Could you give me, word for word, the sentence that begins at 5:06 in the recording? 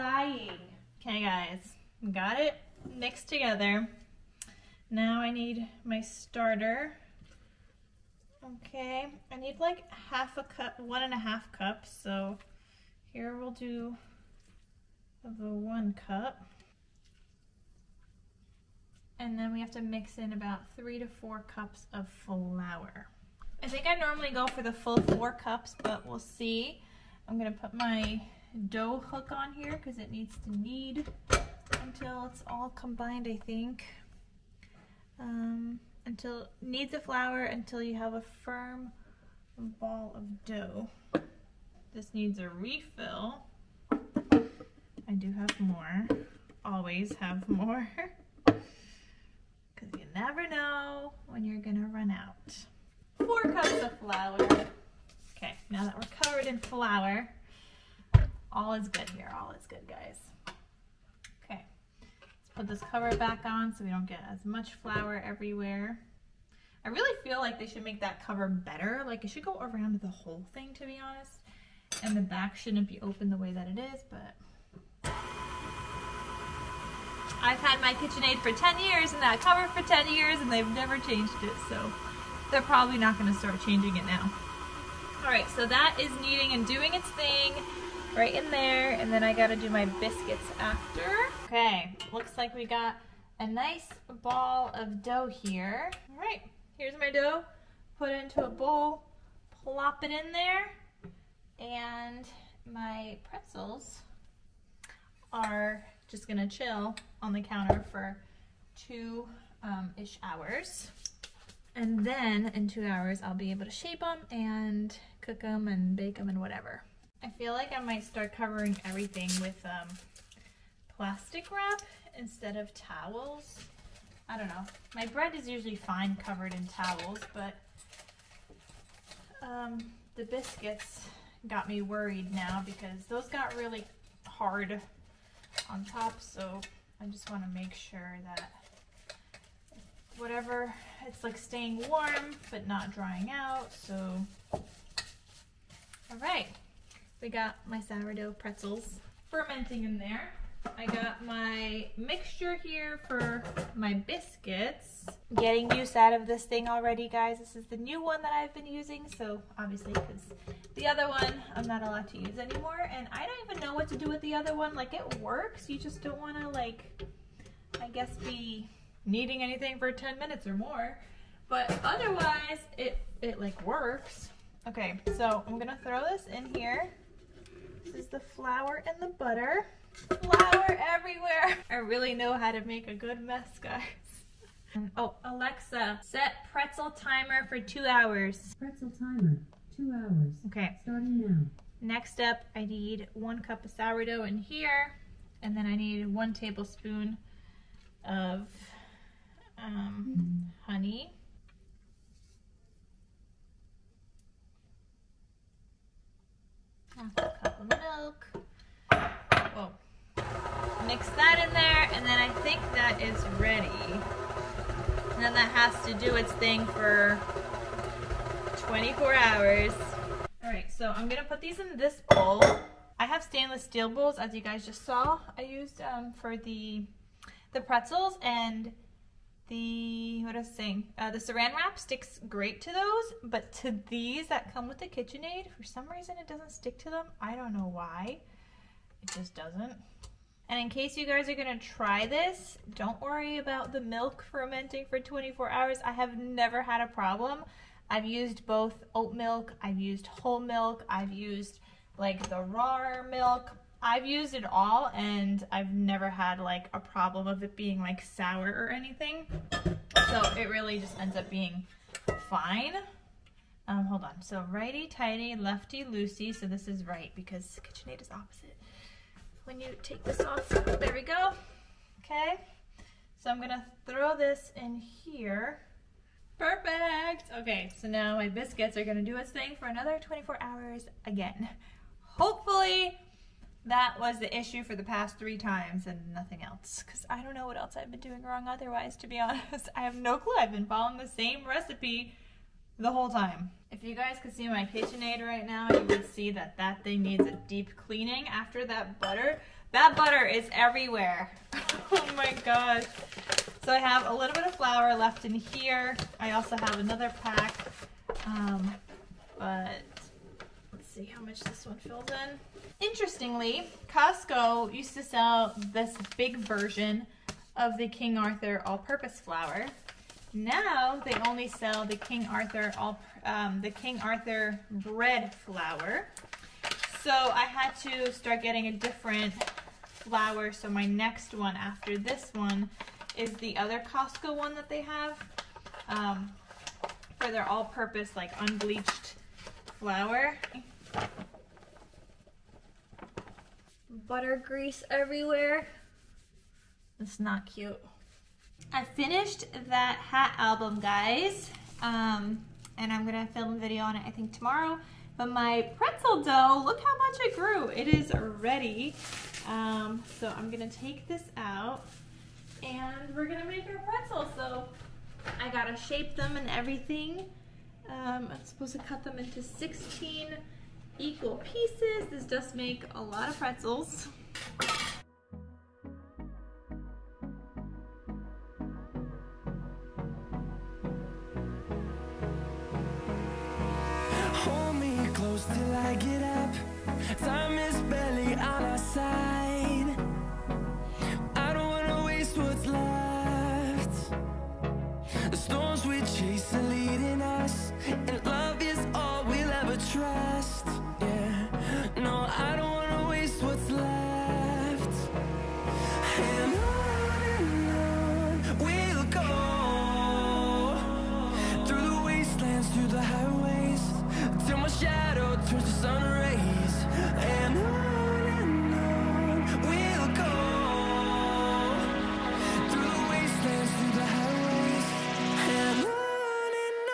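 I also have another pack, um, but see how much this one fills in.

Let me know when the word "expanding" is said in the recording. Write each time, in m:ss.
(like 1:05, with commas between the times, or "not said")
not said.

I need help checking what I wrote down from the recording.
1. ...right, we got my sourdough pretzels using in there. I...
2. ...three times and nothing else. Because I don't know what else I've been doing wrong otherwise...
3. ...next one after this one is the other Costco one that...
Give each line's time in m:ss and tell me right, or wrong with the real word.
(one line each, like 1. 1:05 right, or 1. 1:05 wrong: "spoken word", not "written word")
1. 2:26 wrong: "fermenting", not "using"
2. 4:45 right
3. 5:30 right.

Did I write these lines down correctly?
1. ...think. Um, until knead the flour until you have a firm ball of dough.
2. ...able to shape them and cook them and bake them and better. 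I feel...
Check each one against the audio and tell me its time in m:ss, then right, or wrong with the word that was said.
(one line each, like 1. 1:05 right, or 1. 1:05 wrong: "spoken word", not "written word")
1. 0:33 right
2. 1:53 wrong: "whatever", not "better".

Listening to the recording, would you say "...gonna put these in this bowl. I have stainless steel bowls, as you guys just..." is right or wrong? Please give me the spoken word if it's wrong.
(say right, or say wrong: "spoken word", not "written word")
right.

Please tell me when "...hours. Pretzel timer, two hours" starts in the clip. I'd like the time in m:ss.
3:07.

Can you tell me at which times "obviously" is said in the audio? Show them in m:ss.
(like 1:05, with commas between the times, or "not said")
2:39.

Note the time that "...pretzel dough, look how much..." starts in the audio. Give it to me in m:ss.
5:55.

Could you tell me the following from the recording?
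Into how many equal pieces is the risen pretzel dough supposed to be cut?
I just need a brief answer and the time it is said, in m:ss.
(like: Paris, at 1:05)
16, at 6:09.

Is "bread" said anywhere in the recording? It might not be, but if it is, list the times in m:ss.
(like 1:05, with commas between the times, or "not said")
2:05, 5:24.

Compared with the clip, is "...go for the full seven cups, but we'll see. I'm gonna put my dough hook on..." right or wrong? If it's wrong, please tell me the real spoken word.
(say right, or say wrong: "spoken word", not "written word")
wrong: "four", not "seven".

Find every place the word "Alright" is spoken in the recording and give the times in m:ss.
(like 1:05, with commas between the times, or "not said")
1:25, 1:36.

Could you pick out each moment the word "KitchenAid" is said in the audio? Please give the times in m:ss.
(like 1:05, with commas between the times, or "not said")
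1:17, 3:54, 4:27, 4:54.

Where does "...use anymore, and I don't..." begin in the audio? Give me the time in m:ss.
2:42.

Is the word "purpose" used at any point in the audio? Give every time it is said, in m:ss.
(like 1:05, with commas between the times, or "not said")
5:18, 5:37.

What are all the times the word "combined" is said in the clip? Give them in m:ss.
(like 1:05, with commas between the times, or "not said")
0:32.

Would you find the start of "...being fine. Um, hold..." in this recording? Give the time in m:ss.
4:21.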